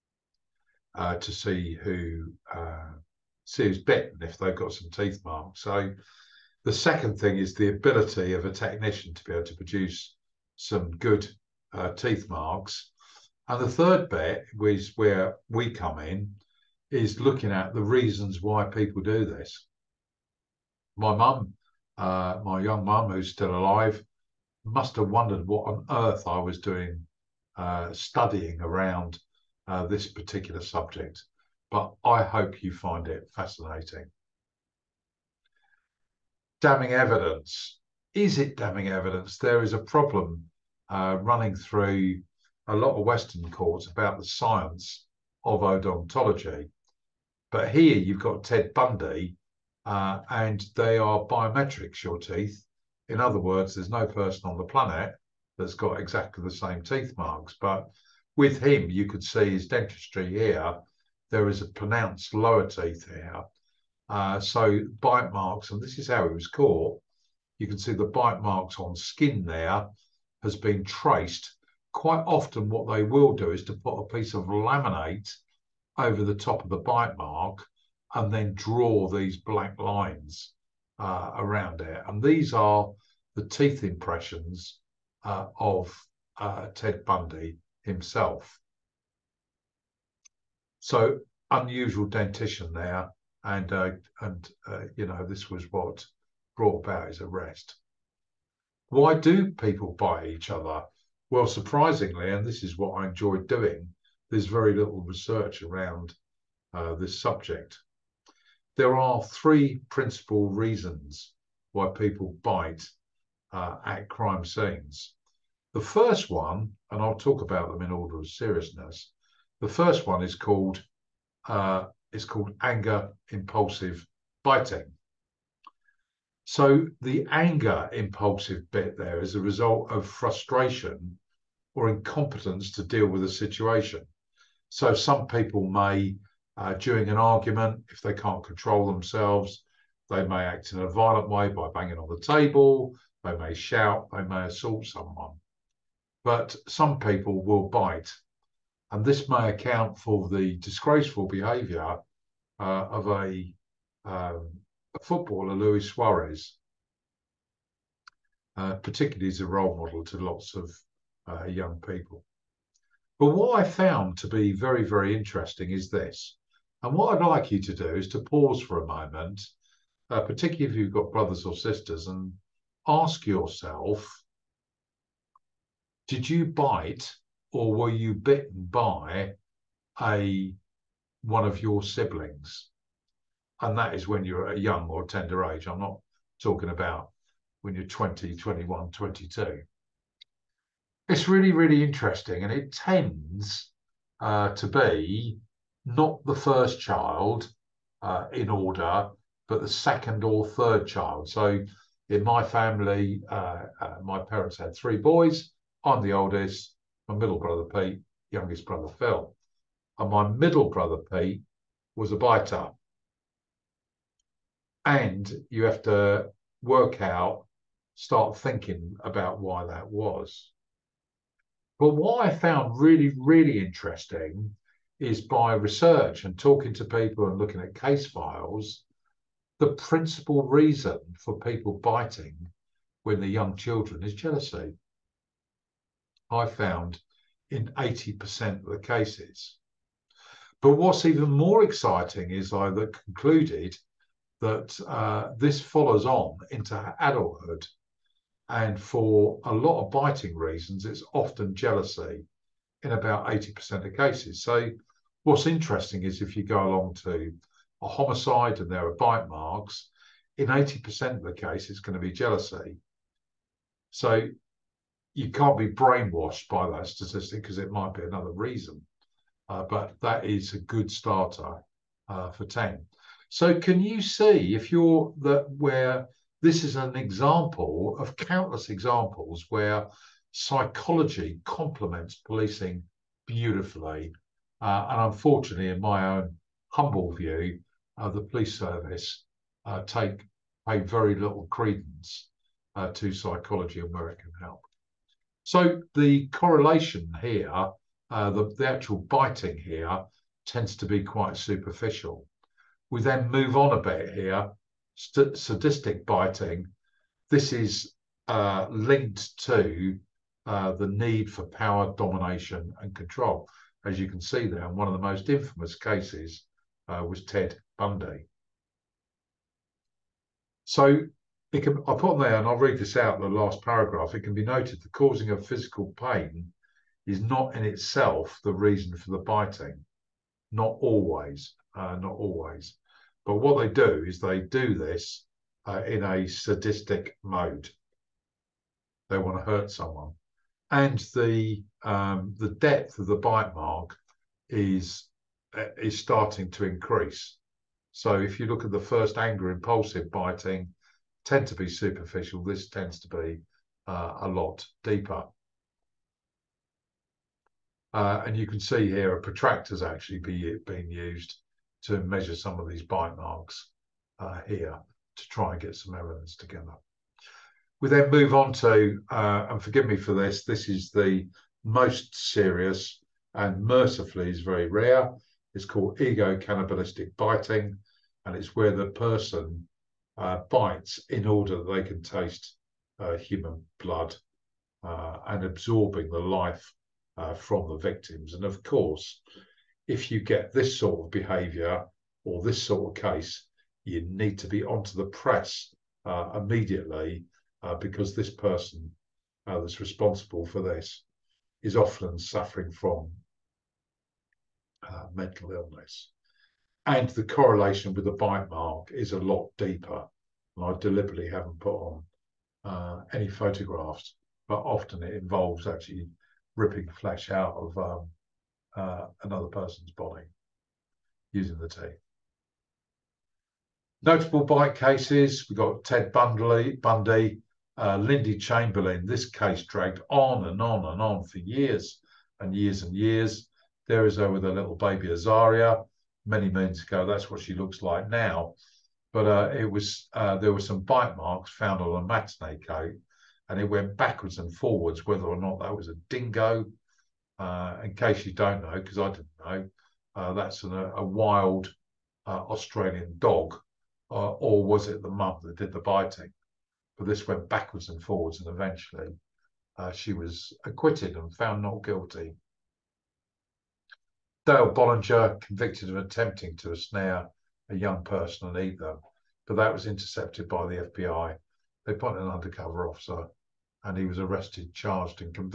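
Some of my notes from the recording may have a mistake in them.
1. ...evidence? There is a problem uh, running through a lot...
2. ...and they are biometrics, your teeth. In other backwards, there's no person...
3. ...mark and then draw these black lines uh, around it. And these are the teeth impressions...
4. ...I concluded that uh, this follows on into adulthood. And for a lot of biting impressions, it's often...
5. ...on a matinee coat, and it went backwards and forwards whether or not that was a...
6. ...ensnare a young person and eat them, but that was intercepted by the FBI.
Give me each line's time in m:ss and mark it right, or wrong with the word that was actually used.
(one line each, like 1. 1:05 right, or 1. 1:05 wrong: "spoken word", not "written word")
1. 0:38 right
2. 0:50 wrong: "words", not "backwards"
3. 1:17 right
4. 4:02 wrong: "reasons", not "impressions"
5. 7:21 right
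6. 7:46 right.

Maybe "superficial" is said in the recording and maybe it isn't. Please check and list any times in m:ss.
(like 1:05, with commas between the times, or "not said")
5:01, 5:51.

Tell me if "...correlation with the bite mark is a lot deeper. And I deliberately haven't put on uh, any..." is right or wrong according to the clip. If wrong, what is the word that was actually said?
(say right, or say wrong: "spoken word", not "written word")
right.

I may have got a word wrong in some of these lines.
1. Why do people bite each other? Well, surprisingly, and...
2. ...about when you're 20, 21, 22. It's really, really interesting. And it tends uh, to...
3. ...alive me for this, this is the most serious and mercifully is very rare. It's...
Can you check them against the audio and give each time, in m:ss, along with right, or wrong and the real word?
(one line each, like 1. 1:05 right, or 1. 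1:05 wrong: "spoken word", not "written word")
1. 1:38 right
2. 3:06 right
3. 6:09 wrong: "forgive", not "alive".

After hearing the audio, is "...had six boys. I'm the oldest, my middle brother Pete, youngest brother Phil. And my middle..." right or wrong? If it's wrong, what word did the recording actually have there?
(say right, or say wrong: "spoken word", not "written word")
wrong: "three", not "six".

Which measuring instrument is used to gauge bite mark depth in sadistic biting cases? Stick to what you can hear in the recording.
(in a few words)
protractor.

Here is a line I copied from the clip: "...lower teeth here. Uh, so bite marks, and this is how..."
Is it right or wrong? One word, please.
right.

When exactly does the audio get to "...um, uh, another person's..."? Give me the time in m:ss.
6:57.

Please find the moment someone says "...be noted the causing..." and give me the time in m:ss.
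5:24.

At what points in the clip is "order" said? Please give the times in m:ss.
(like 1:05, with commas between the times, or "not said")
1:57, 3:18, 6:21.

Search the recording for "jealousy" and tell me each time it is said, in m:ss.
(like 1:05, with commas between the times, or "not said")
3:54, 4:11, 4:22.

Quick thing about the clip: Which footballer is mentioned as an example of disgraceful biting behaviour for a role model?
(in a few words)
Luis Suarez.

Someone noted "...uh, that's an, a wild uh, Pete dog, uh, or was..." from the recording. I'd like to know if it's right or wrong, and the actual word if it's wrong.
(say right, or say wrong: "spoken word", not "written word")
wrong: "Australian", not "Pete".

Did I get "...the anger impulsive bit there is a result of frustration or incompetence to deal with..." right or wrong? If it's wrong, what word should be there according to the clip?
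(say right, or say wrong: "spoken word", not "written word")
right.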